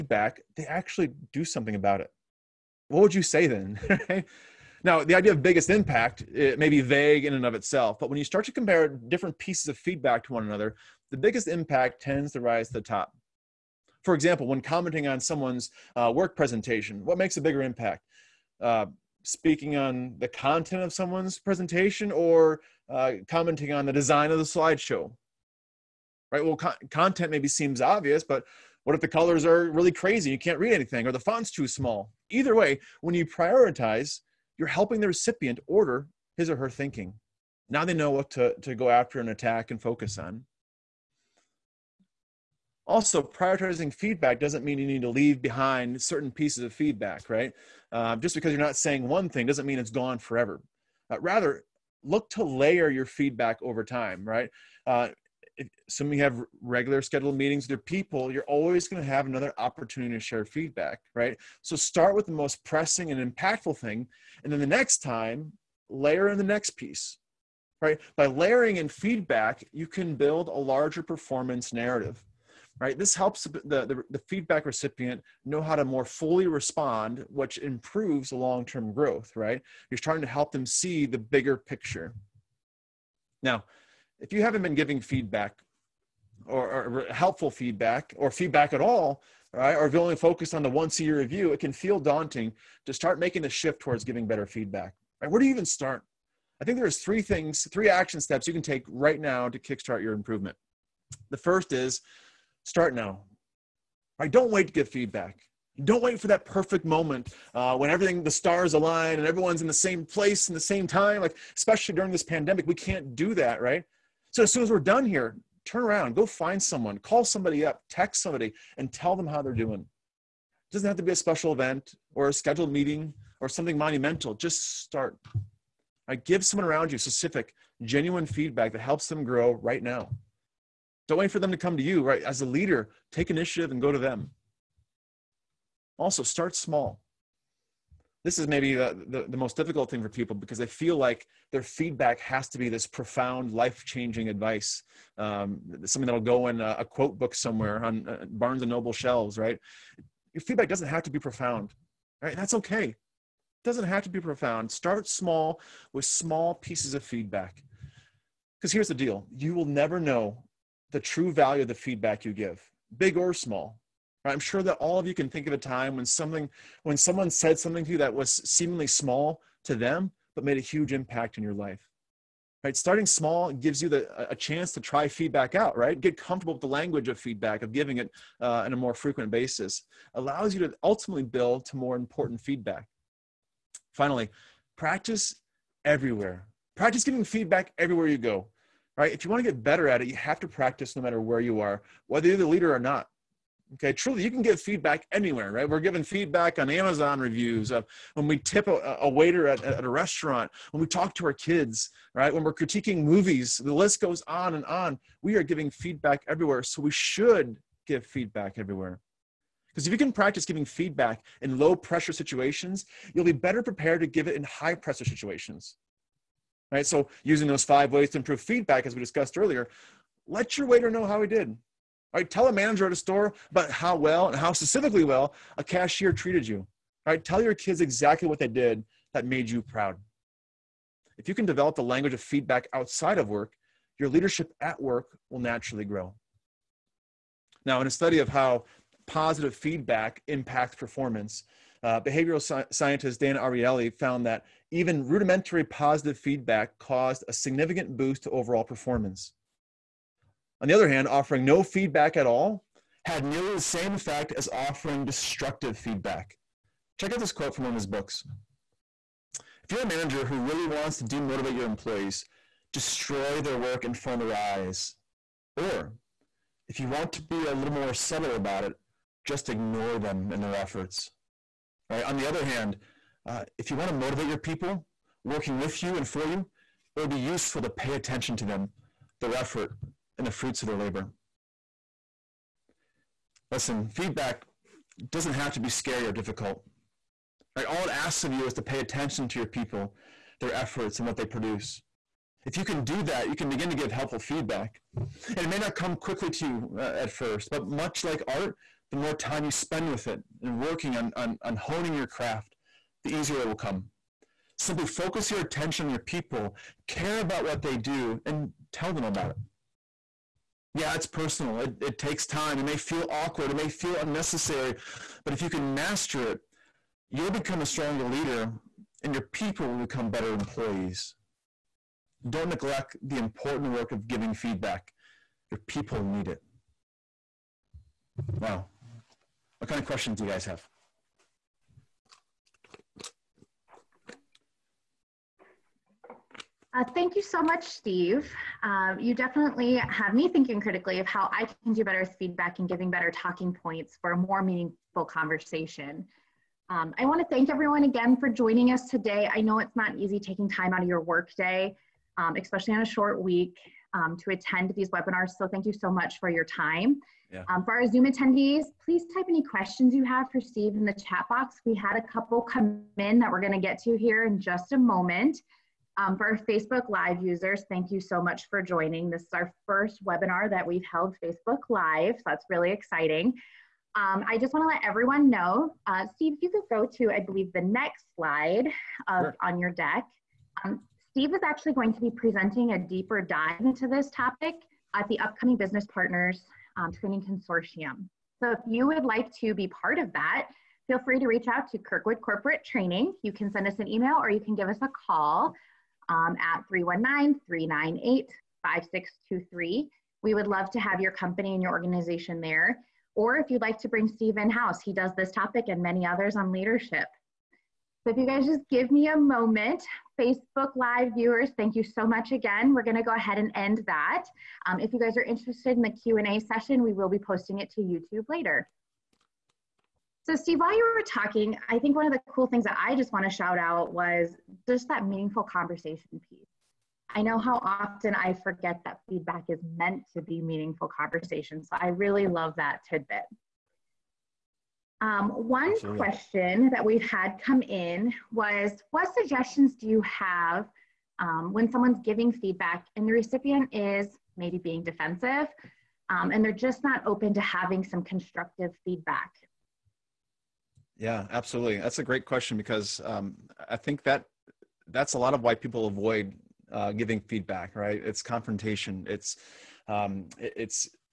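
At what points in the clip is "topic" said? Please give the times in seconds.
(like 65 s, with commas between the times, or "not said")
384 s, 405 s.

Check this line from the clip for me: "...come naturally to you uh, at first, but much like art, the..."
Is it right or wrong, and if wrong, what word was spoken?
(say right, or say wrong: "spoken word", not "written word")
wrong: "quickly", not "naturally".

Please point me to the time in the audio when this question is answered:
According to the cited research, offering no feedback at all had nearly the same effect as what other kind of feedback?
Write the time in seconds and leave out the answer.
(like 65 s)
255 s.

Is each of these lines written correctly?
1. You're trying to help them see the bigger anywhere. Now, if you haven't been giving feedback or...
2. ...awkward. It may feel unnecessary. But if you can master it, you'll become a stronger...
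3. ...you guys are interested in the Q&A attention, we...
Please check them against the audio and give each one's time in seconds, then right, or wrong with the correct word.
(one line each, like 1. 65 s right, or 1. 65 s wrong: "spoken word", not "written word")
1. 79 s wrong: "picture", not "anywhere"
2. 313 s right
3. 414 s wrong: "session", not "attention".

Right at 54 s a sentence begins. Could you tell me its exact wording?
Uh, assuming you have regular scheduled meetings with your people, you're always going to have another opportunity to share feedback, right?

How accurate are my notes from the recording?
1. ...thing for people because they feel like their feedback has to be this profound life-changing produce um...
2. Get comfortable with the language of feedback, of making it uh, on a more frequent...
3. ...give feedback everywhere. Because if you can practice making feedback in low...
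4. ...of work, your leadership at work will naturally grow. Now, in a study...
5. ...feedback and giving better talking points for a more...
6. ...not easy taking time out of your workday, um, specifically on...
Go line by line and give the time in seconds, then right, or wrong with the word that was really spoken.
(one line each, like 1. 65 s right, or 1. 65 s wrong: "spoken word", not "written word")
1. 139 s wrong: "advice", not "produce"
2. 175 s wrong: "giving", not "making"
3. 207 s wrong: "giving", not "making"
4. 233 s right
5. 342 s right
6. 349 s wrong: "especially", not "specifically".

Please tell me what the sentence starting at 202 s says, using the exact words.
When we're critiquing movies, the list goes on and on.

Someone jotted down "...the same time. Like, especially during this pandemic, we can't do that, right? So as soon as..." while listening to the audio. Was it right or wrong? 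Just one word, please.
right.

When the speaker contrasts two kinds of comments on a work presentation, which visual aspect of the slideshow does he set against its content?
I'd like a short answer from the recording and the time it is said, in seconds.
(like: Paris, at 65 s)
design, at 23 s.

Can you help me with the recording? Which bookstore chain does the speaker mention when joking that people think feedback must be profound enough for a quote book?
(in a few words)
Barnes and Noble.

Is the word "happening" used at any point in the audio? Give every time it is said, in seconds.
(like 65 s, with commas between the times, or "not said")
not said.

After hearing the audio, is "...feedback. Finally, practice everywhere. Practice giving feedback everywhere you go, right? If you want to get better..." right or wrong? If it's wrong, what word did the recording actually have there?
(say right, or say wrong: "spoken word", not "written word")
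right.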